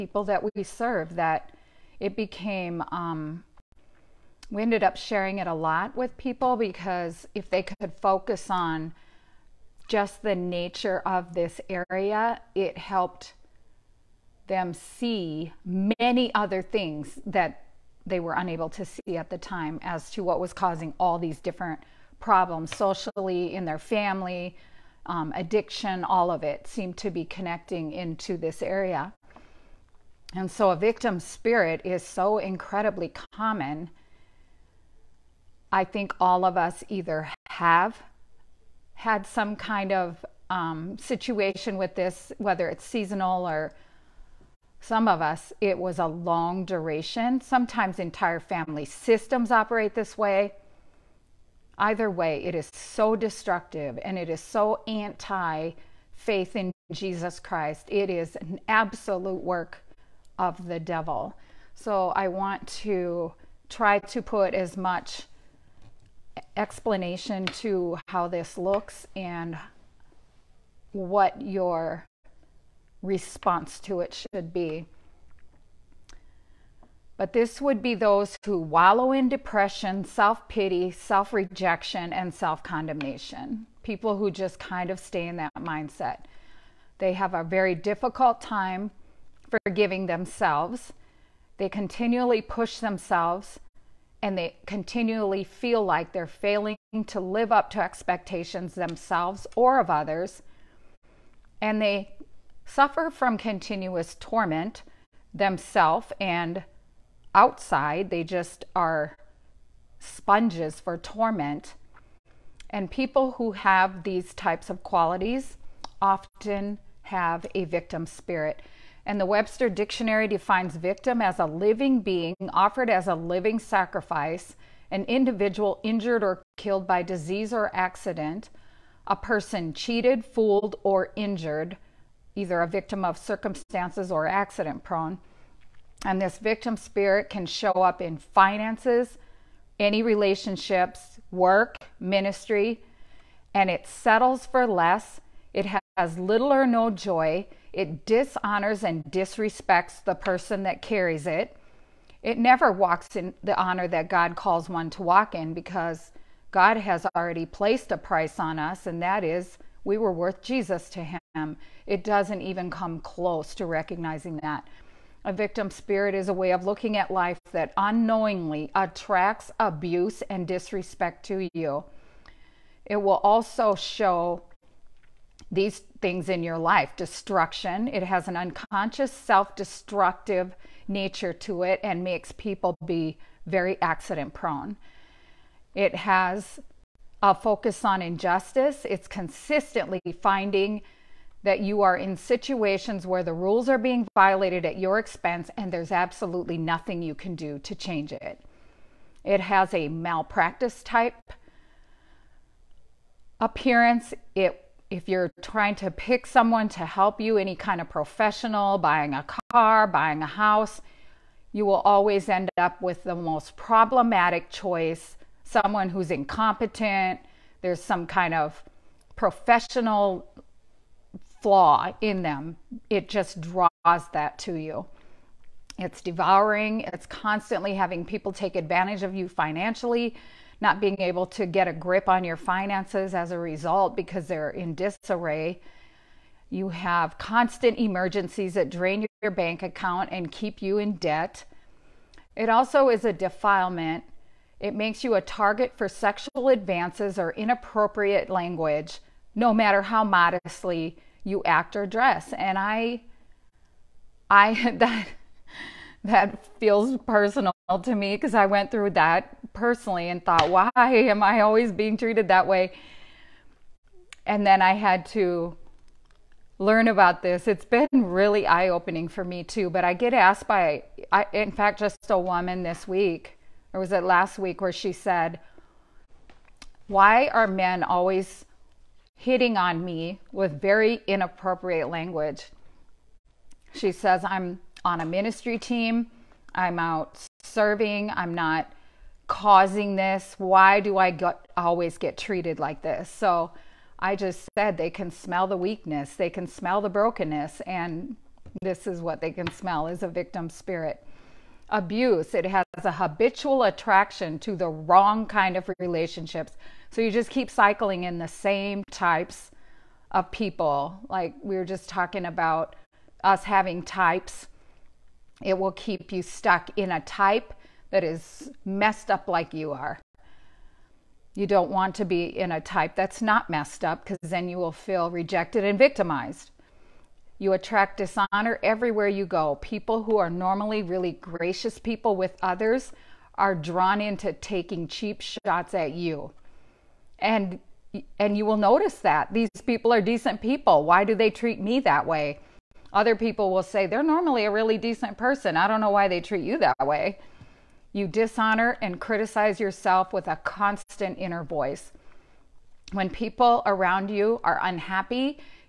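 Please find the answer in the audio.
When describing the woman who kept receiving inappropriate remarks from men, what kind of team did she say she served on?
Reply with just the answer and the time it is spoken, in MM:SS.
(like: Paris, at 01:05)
ministry team, at 04:45.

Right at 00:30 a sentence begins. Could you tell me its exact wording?
And so a victim spirit is so incredibly common.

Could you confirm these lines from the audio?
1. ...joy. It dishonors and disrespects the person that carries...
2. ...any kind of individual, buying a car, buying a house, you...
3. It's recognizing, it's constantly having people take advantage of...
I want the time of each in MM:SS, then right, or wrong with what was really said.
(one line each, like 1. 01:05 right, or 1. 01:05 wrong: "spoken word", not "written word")
1. 02:26 right
2. 03:27 wrong: "professional", not "individual"
3. 03:45 wrong: "devouring", not "recognizing".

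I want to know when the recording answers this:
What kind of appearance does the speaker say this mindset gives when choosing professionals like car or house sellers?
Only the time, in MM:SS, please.
03:19.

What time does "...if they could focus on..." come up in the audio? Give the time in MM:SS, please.
00:07.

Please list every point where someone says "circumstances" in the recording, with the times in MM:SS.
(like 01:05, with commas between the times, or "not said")
02:13.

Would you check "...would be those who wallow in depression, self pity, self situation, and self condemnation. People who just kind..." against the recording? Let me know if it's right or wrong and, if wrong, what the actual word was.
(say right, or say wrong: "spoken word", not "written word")
wrong: "rejection", not "situation".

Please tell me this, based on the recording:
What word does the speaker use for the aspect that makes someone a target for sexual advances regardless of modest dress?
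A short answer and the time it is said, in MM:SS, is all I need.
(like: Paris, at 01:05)
defilement, at 04:03.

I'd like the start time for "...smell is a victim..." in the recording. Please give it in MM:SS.
04:59.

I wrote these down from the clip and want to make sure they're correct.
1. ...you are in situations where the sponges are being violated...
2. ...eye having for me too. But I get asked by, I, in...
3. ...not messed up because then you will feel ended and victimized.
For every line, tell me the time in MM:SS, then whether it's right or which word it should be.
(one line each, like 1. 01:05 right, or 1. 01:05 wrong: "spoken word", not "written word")
1. 03:11 wrong: "rules", not "sponges"
2. 04:28 wrong: "opening", not "having"
3. 05:23 wrong: "rejected", not "ended".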